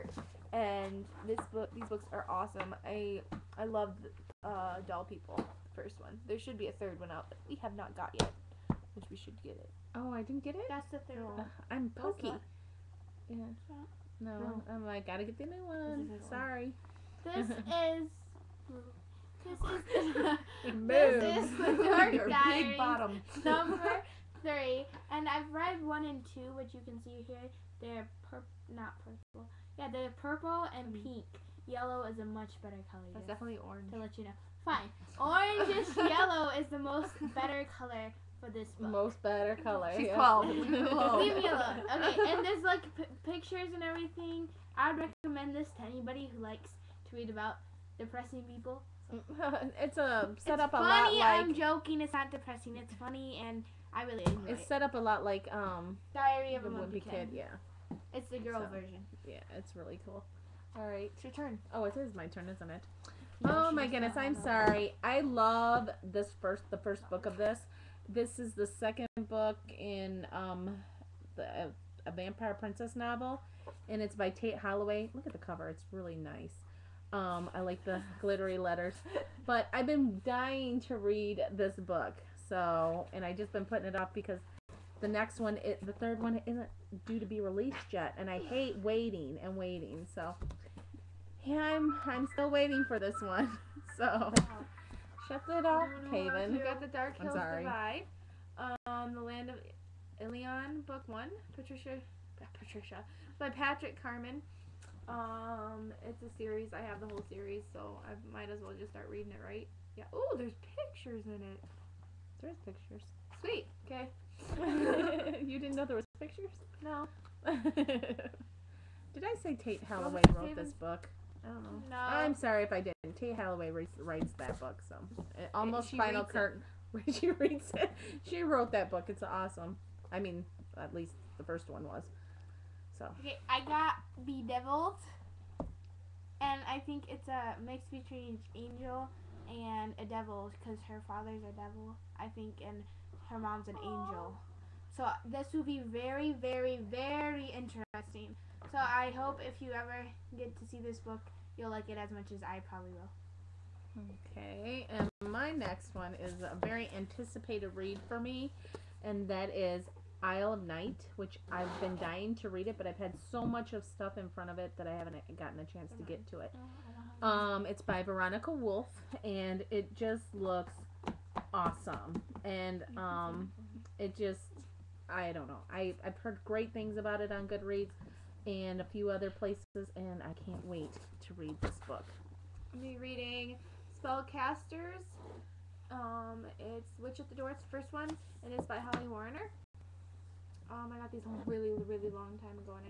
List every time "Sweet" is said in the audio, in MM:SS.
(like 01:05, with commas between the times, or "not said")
01:53.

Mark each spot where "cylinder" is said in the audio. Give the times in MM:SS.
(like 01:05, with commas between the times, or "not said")
not said.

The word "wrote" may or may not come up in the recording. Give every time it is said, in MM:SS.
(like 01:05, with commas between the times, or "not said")
02:00, 02:08.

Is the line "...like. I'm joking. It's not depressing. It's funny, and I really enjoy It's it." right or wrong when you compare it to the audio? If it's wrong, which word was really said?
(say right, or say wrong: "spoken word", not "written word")
right.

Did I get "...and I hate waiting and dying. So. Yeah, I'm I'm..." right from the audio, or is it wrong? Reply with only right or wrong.
wrong.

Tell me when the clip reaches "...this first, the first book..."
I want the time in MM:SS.
01:06.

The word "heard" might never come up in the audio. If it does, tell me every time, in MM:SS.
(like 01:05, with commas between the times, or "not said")
02:56.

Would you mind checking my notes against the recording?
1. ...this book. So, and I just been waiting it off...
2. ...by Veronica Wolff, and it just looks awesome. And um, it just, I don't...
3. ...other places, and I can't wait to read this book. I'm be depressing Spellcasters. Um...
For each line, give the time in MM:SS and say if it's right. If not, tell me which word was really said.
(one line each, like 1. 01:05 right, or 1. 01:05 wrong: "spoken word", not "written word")
1. 01:21 wrong: "putting", not "waiting"
2. 02:47 right
3. 02:59 wrong: "reading", not "depressing".